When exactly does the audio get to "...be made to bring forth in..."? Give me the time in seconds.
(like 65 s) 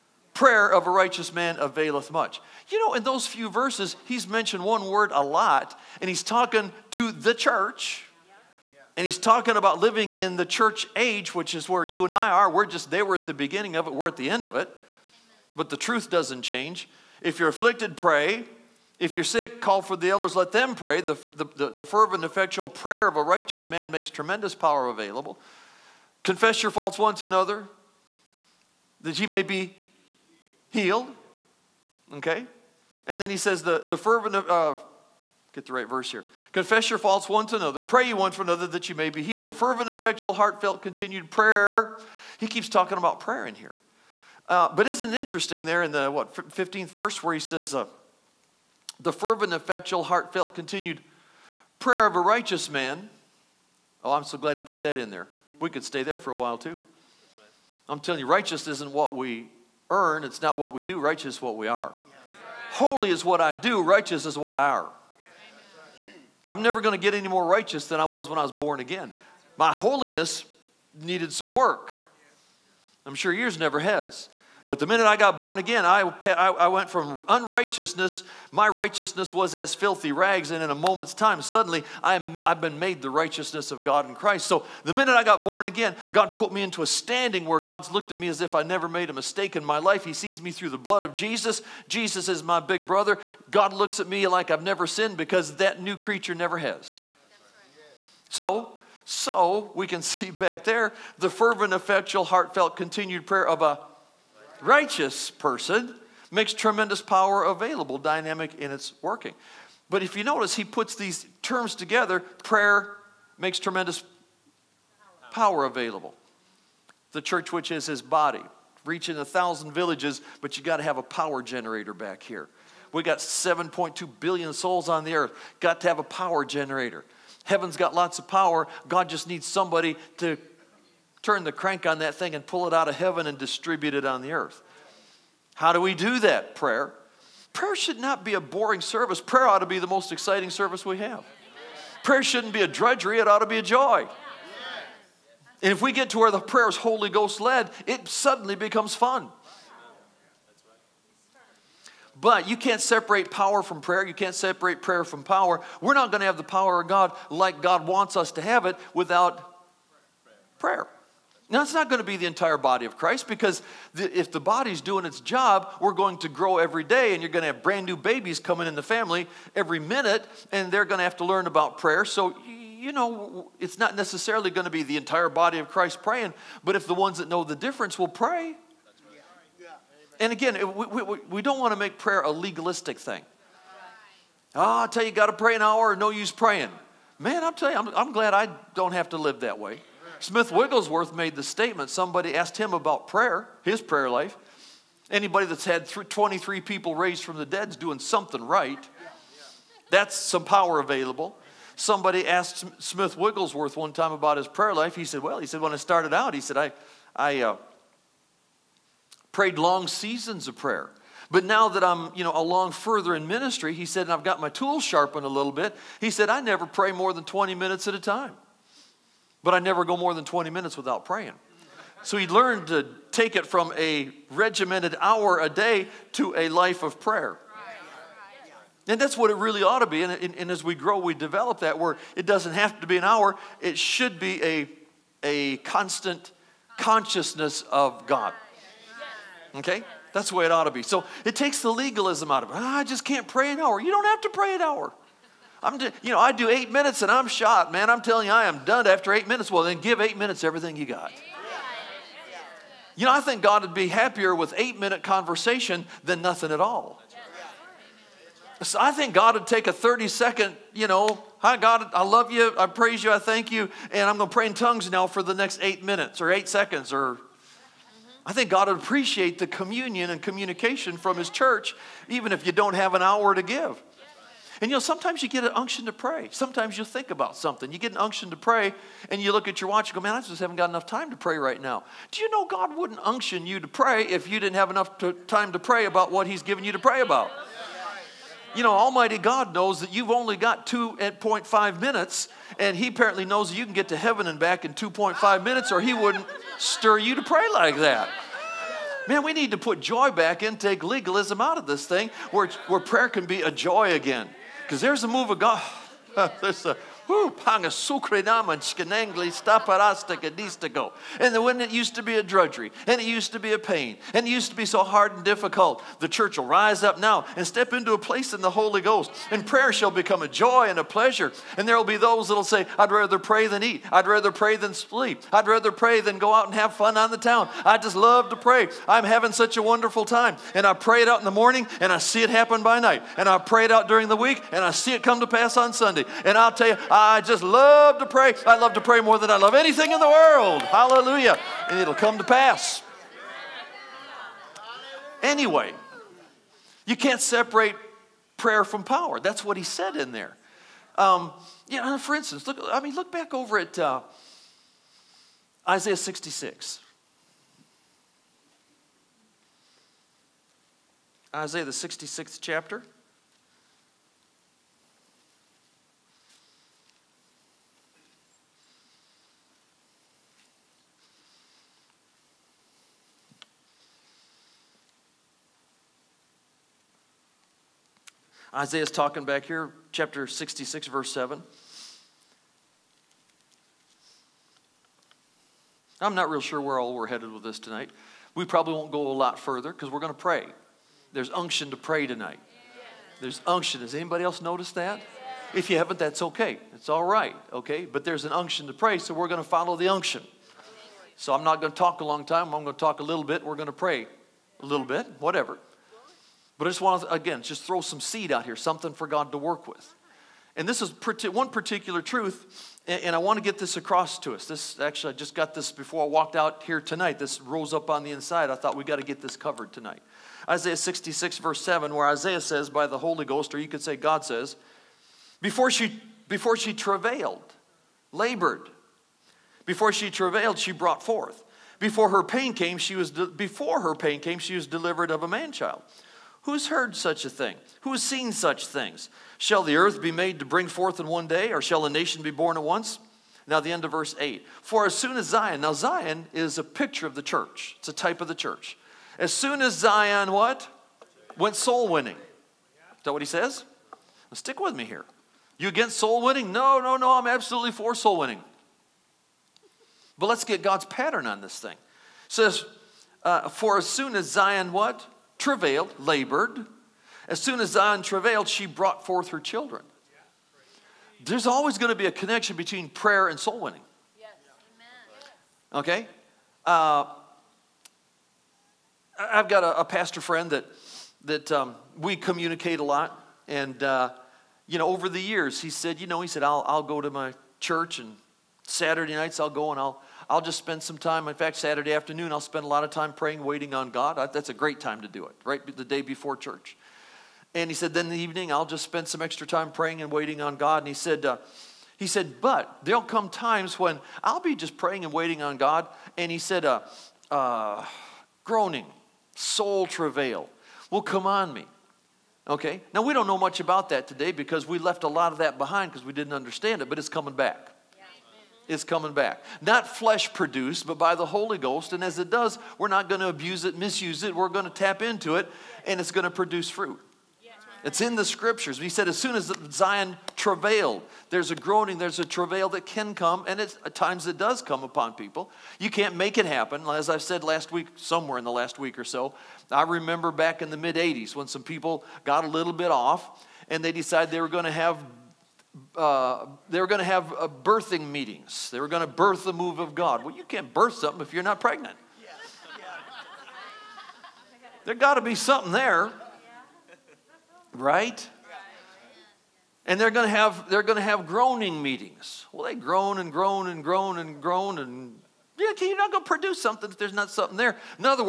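440 s.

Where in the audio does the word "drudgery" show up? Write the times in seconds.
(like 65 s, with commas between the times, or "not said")
142 s, 312 s.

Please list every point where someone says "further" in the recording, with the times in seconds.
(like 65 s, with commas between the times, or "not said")
212 s, 389 s.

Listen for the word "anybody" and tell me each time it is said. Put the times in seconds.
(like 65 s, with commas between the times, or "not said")
195 s, 393 s.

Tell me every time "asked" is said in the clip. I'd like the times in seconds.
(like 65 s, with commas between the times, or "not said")
192 s, 202 s.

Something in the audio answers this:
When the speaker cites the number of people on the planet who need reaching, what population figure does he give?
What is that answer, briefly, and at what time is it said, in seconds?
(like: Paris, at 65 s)
7.2 billion, at 123 s.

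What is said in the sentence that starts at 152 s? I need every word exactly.
But you can't separate power from prayer.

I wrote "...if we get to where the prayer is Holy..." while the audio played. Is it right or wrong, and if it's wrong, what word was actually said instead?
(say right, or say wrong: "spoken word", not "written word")
right.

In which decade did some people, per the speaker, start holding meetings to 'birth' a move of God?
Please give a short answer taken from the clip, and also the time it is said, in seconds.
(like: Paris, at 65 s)
mid 80s, at 540 s.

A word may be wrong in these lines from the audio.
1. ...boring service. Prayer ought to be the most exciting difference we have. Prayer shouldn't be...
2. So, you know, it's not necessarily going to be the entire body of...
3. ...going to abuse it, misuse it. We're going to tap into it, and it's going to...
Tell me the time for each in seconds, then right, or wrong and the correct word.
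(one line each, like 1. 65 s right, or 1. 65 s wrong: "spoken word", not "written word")
1. 138 s wrong: "service", not "difference"
2. 172 s right
3. 523 s right.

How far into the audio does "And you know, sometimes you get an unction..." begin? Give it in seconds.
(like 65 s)
274 s.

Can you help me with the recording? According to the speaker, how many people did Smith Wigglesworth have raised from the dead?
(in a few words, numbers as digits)
23.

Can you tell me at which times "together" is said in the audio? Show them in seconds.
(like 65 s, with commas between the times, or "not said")
111 s.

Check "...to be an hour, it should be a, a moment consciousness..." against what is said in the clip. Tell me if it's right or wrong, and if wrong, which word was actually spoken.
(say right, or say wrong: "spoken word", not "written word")
wrong: "constant", not "moment".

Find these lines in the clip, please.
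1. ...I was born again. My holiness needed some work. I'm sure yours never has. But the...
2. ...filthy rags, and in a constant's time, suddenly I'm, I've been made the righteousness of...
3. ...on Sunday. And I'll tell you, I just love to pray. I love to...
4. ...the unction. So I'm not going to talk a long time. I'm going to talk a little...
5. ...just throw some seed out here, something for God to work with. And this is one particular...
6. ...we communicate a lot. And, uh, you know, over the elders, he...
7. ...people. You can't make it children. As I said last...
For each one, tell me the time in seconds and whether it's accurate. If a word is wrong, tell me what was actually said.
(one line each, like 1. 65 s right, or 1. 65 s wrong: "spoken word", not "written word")
1. 68 s right
2. 79 s wrong: "moment", not "constant"
3. 335 s right
4. 399 s right
5. 407 s right
6. 481 s wrong: "years", not "elders"
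7. 535 s wrong: "happen", not "children".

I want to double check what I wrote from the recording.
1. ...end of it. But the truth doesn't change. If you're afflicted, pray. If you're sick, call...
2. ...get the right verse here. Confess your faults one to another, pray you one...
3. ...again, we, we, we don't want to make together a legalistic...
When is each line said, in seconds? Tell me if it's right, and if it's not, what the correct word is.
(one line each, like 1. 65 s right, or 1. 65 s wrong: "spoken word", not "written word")
1. 14 s right
2. 35 s right
3. 180 s wrong: "prayer", not "together".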